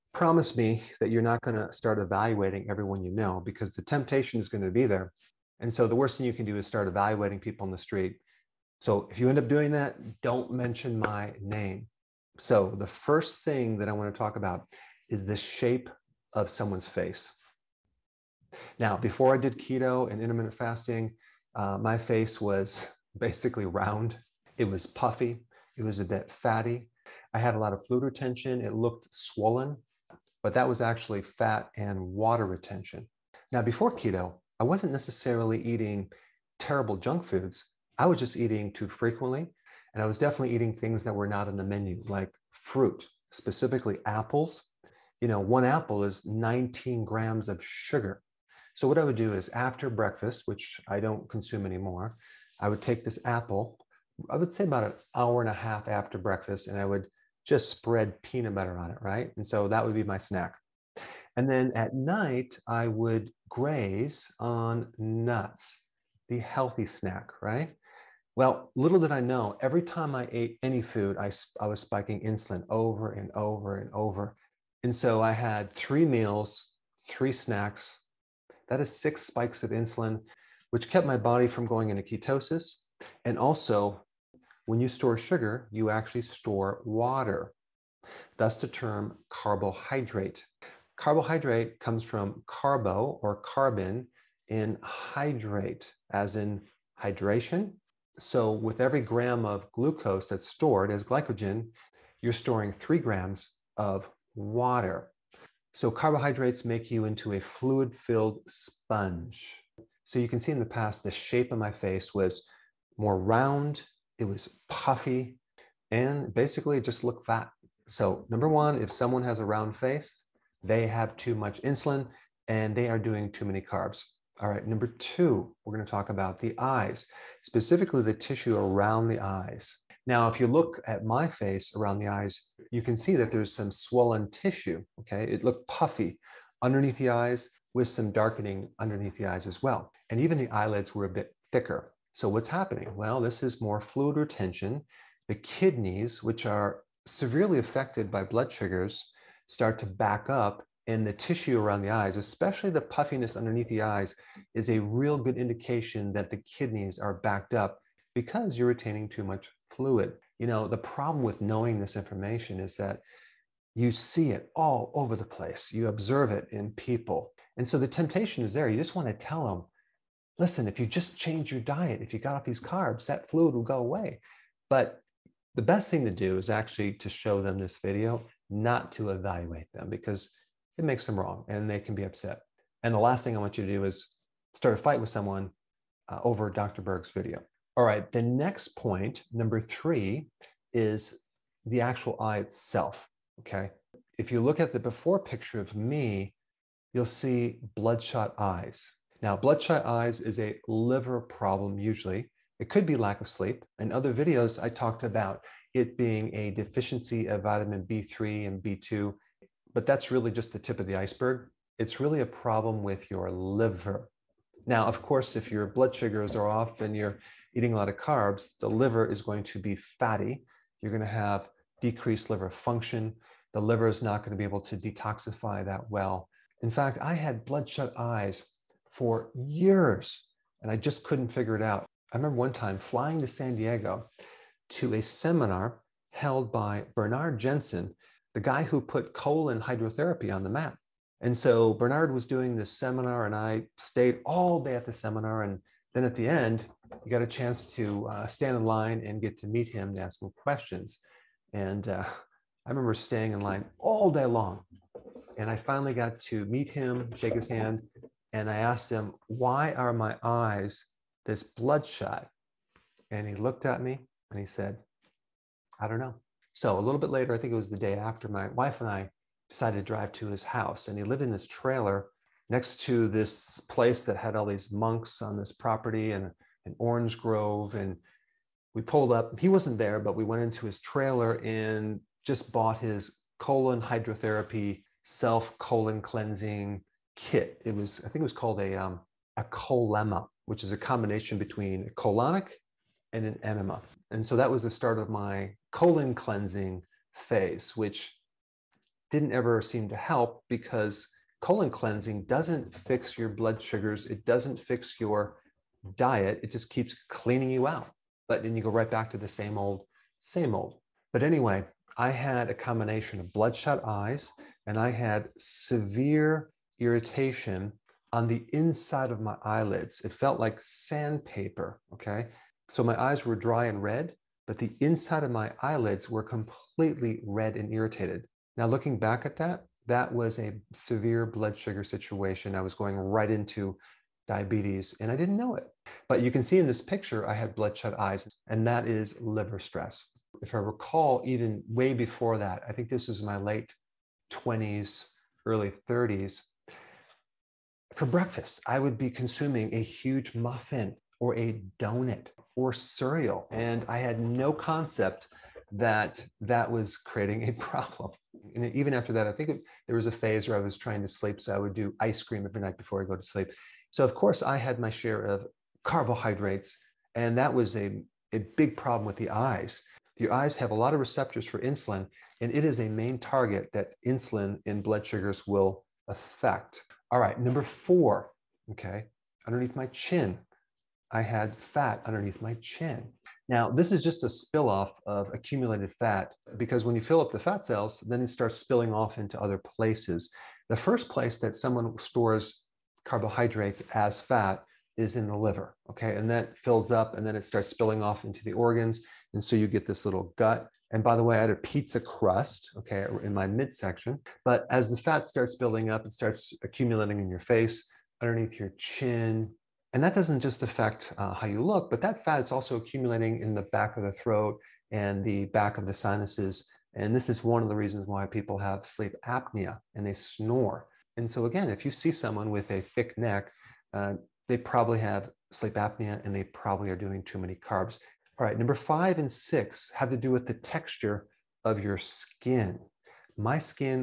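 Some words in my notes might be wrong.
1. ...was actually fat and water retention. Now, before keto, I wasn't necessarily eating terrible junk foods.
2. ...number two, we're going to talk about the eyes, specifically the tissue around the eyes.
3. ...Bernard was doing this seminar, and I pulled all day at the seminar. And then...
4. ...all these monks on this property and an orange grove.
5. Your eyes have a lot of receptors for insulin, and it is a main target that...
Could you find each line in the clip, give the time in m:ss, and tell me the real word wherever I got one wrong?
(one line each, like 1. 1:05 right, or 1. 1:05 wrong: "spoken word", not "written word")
1. 0:30 right
2. 2:04 right
3. 4:01 wrong: "stayed", not "pulled"
4. 4:34 right
5. 6:10 right.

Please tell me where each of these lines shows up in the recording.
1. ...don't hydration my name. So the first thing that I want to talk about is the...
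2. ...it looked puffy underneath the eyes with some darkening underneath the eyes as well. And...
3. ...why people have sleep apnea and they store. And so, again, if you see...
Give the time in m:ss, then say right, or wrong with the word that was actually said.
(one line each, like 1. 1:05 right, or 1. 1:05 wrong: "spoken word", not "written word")
1. 0:10 wrong: "mention", not "hydration"
2. 2:15 right
3. 6:58 wrong: "snore", not "store".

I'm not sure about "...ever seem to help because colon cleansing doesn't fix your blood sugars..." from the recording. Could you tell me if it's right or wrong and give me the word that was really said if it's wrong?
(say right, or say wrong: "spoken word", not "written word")
right.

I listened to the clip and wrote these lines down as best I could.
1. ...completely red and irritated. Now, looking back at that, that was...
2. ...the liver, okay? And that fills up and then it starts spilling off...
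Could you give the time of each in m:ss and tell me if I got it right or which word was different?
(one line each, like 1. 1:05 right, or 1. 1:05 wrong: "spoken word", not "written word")
1. 5:26 right
2. 6:35 right.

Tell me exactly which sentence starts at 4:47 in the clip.
It was, I think it was called a, um, a colema, which is a combination between a colonic and an enema.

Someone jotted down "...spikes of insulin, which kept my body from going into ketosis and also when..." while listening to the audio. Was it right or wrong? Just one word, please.
right.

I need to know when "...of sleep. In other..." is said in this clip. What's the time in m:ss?
3:23.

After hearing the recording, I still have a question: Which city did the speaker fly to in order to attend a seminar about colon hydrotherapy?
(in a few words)
San Diego.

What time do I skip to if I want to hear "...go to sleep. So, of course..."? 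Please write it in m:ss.
6:03.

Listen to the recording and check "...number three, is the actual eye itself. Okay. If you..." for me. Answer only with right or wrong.
right.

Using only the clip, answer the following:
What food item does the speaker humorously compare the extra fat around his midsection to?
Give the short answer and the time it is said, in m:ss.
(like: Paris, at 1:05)
Pizza crust, at 6:41.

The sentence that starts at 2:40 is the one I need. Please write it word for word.
You know, the problem with knowing this information is that you see it all over the place.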